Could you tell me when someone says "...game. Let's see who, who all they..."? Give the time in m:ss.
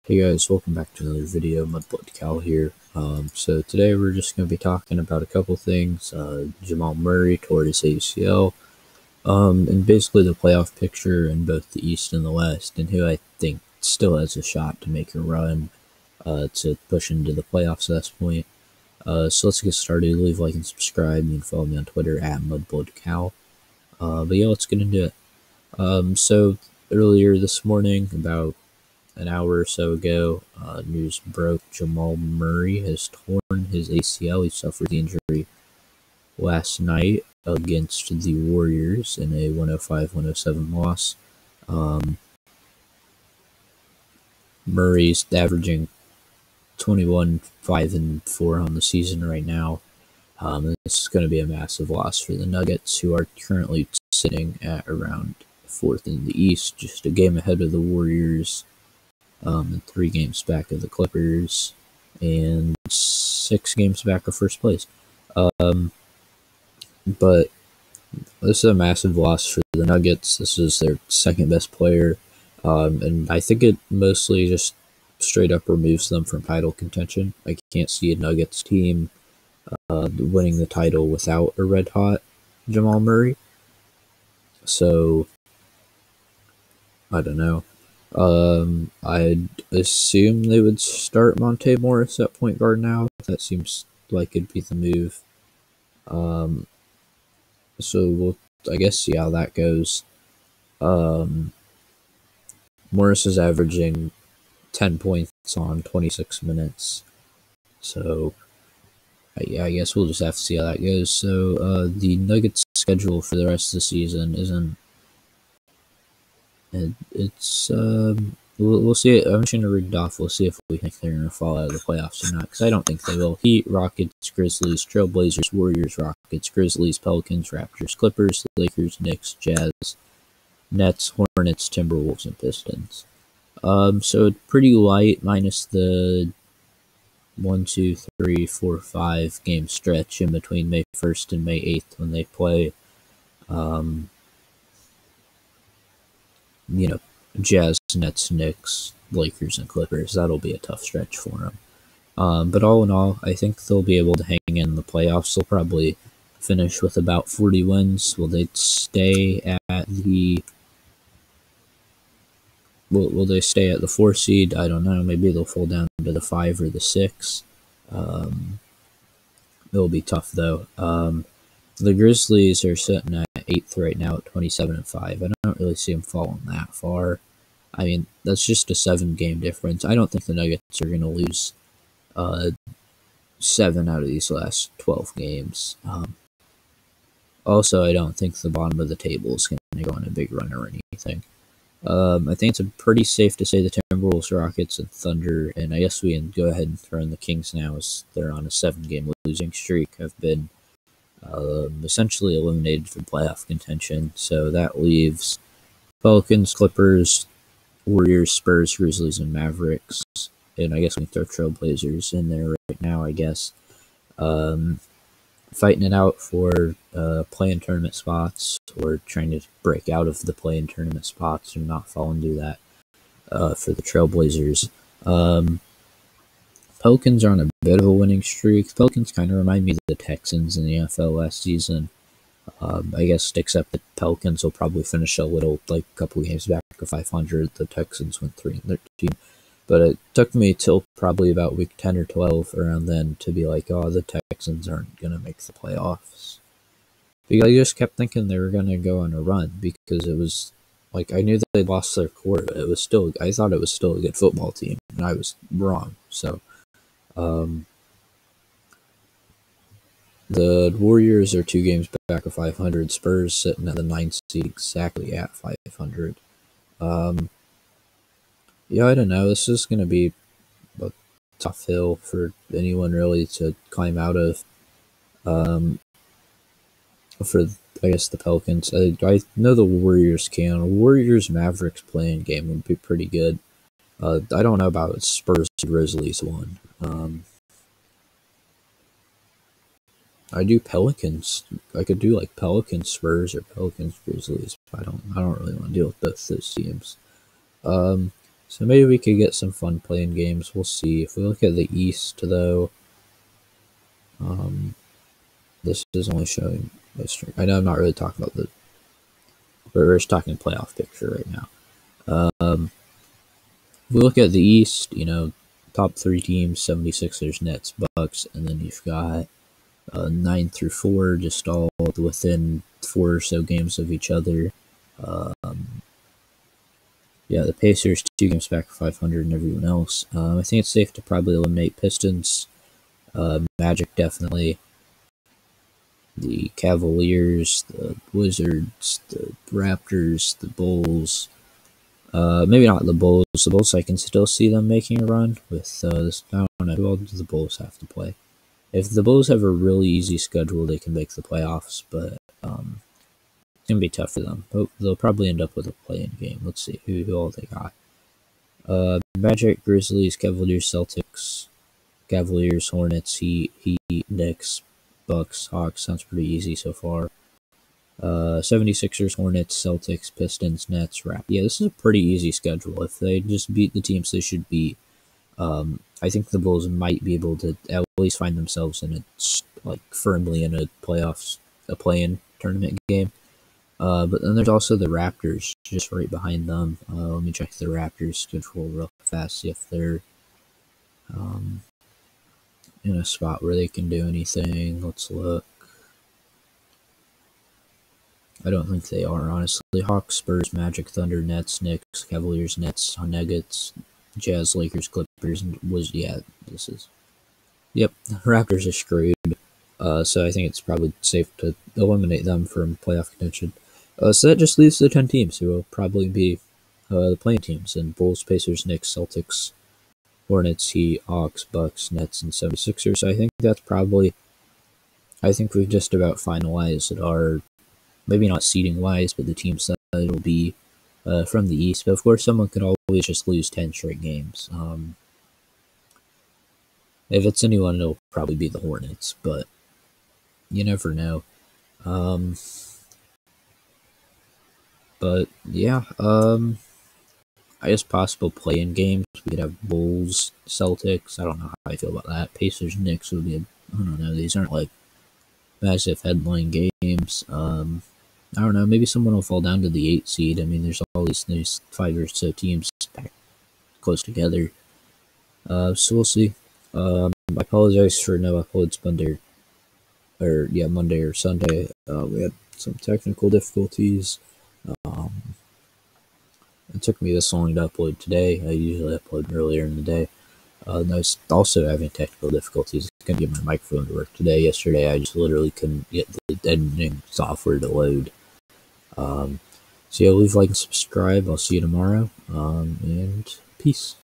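5:56.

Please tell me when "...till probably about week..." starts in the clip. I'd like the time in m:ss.
4:00.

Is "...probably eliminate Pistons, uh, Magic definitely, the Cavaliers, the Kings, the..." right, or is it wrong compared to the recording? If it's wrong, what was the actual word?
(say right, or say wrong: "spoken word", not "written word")
wrong: "Wizards", not "Kings".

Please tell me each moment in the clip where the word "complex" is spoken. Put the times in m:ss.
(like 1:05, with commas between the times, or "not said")
not said.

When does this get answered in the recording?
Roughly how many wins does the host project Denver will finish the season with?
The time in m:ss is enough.
2:36.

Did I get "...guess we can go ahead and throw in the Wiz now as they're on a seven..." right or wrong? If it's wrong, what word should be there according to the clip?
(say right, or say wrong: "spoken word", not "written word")
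wrong: "Kings", not "Wiz".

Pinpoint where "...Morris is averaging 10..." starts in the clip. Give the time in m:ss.
1:42.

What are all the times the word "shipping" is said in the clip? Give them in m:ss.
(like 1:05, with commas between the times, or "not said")
not said.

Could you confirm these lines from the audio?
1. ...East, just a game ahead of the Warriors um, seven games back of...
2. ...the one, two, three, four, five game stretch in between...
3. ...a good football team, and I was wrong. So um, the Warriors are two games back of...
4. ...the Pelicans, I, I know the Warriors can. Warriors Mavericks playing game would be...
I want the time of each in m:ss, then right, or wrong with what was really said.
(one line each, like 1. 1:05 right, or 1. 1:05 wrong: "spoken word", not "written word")
1. 0:56 wrong: "three", not "seven"
2. 2:15 right
3. 4:13 right
4. 4:38 right.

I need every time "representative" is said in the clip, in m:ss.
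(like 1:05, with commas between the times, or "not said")
not said.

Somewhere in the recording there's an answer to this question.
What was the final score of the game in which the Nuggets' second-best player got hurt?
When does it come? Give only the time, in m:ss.
0:39.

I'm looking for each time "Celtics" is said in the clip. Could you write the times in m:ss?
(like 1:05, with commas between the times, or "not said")
6:00, 6:09, 6:58, 7:30.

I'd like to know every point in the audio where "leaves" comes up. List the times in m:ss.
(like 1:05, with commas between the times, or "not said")
0:20, 3:24, 6:54, 8:10.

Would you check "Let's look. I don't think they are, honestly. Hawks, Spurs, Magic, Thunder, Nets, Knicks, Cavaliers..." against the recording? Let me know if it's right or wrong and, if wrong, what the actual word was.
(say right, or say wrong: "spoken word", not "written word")
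right.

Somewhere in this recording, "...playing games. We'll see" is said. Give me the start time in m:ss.
4:59.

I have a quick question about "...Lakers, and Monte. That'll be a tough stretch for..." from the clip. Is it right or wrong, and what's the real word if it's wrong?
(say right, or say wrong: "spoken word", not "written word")
wrong: "Clippers", not "Monte".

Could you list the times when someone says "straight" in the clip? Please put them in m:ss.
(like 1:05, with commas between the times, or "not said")
1:15, 7:13.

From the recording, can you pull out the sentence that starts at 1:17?
I can't see a Nuggets team uh, winning the title without a red hot Jamal Murray.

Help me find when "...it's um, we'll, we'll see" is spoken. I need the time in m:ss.
1:57.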